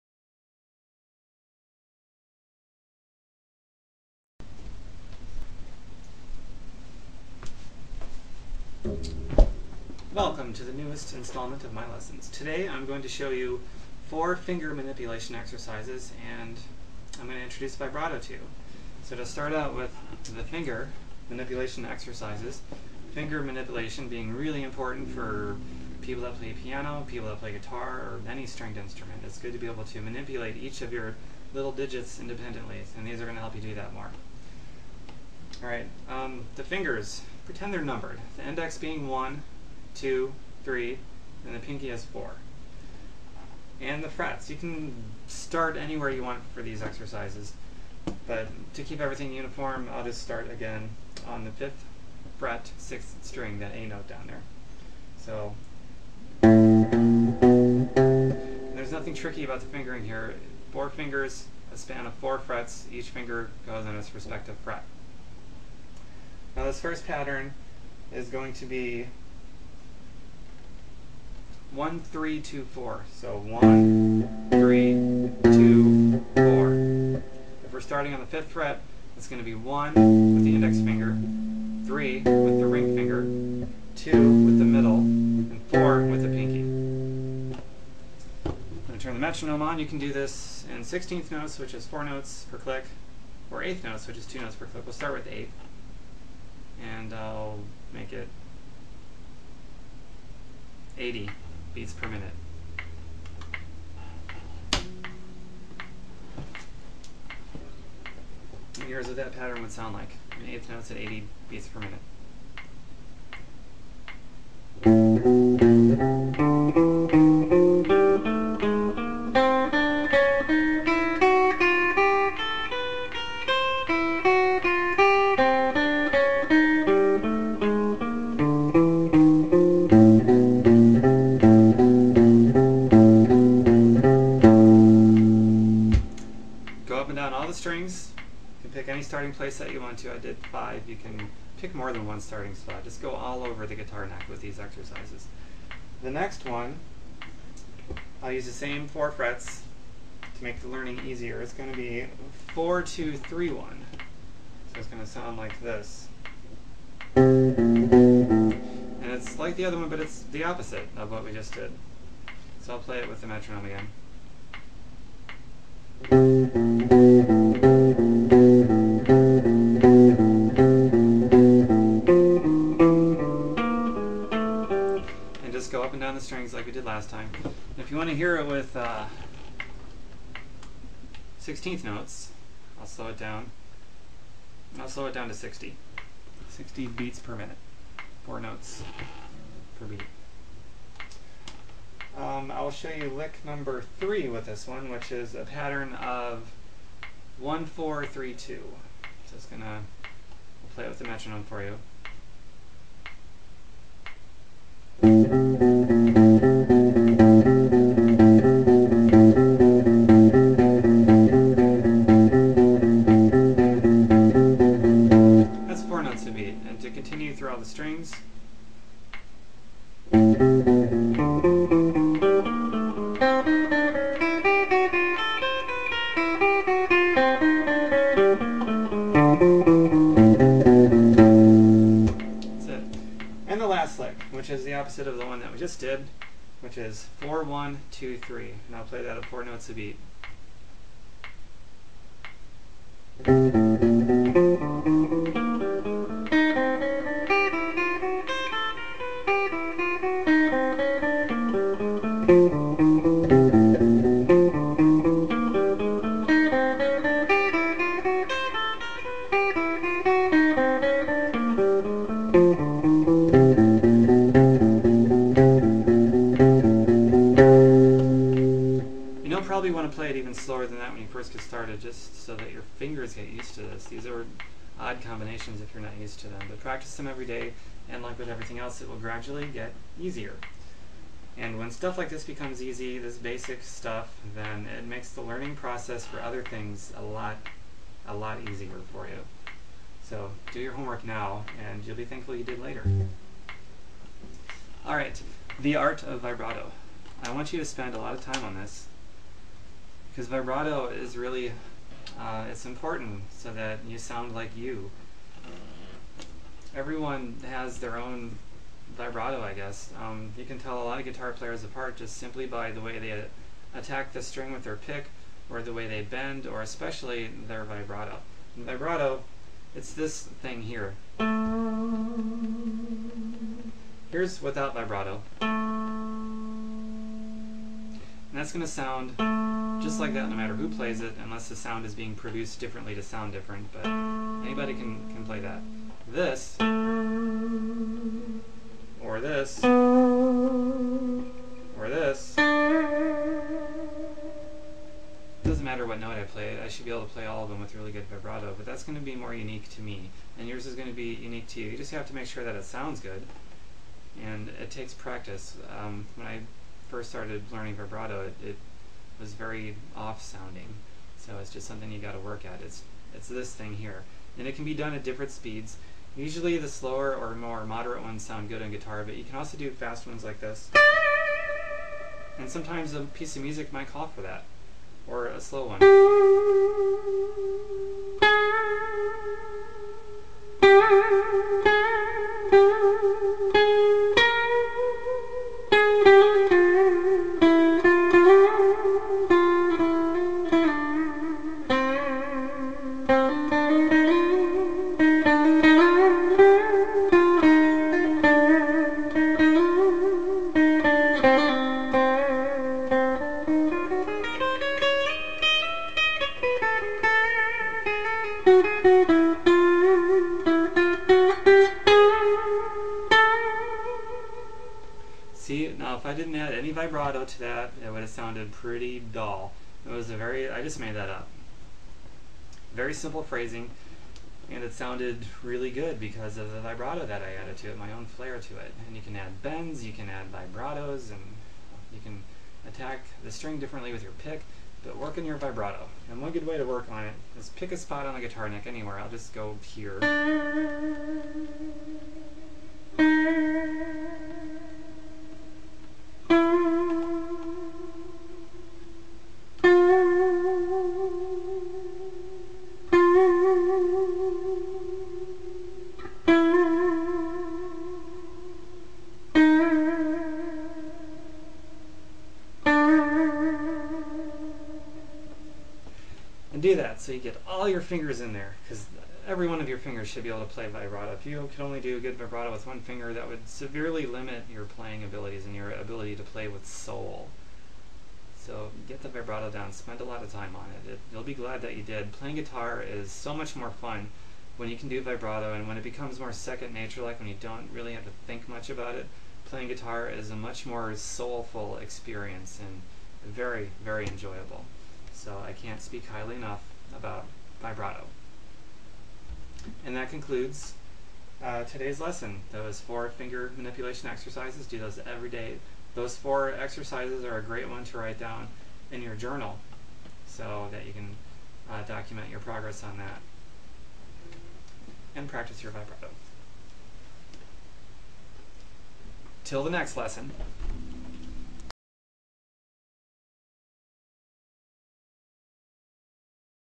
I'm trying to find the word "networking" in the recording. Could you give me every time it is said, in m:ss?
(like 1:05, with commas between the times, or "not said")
not said.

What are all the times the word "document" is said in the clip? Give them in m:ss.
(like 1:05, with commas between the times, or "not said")
8:31.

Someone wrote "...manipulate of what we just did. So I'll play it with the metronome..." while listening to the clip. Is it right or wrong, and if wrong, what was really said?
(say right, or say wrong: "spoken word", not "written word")
wrong: "opposite", not "manipulate".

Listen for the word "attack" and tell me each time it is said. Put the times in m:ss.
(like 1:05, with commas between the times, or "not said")
5:13, 7:12.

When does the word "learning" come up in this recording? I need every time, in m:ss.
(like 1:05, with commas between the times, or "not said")
2:30, 4:45, 5:57.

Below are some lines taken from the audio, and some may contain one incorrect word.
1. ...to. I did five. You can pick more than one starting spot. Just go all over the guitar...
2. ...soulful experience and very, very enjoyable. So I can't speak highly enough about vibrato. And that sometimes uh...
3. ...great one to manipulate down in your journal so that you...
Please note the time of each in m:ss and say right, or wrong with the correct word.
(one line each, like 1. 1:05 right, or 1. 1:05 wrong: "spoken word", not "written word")
1. 2:19 right
2. 8:10 wrong: "concludes", not "sometimes"
3. 8:27 wrong: "write", not "manipulate".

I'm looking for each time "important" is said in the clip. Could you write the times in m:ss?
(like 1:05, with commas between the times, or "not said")
0:24, 5:02.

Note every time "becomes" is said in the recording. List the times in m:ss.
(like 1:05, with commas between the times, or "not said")
4:42, 8:05.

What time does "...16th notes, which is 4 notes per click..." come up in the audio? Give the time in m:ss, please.
1:30.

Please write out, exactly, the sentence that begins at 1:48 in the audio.
here's what that pattern would sound like.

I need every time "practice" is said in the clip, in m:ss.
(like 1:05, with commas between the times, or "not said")
4:36, 5:54, 8:35.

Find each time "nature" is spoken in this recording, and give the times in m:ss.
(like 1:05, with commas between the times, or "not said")
8:06.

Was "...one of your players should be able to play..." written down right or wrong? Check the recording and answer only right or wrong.
wrong.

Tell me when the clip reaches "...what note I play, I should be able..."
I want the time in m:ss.
5:45.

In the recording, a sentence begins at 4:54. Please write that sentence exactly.
All right, the art of vibrato.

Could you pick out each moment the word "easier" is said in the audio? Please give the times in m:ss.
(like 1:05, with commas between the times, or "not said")
2:31, 4:39, 4:48.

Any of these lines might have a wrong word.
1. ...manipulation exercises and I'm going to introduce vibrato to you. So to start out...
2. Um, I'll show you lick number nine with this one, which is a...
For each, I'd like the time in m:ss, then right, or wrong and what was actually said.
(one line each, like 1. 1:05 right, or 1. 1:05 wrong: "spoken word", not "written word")
1. 0:14 right
2. 3:12 wrong: "three", not "nine".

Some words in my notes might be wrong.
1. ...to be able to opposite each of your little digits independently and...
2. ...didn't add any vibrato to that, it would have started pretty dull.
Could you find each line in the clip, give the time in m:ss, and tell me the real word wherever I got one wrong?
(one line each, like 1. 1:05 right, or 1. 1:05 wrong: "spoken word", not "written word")
1. 0:29 wrong: "manipulate", not "opposite"
2. 6:56 wrong: "sounded", not "started".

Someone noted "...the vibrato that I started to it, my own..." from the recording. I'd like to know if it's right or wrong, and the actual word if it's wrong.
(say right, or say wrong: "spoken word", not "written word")
wrong: "added", not "started".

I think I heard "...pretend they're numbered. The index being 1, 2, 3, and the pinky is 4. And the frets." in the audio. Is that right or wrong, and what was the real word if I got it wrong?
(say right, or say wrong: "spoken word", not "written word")
right.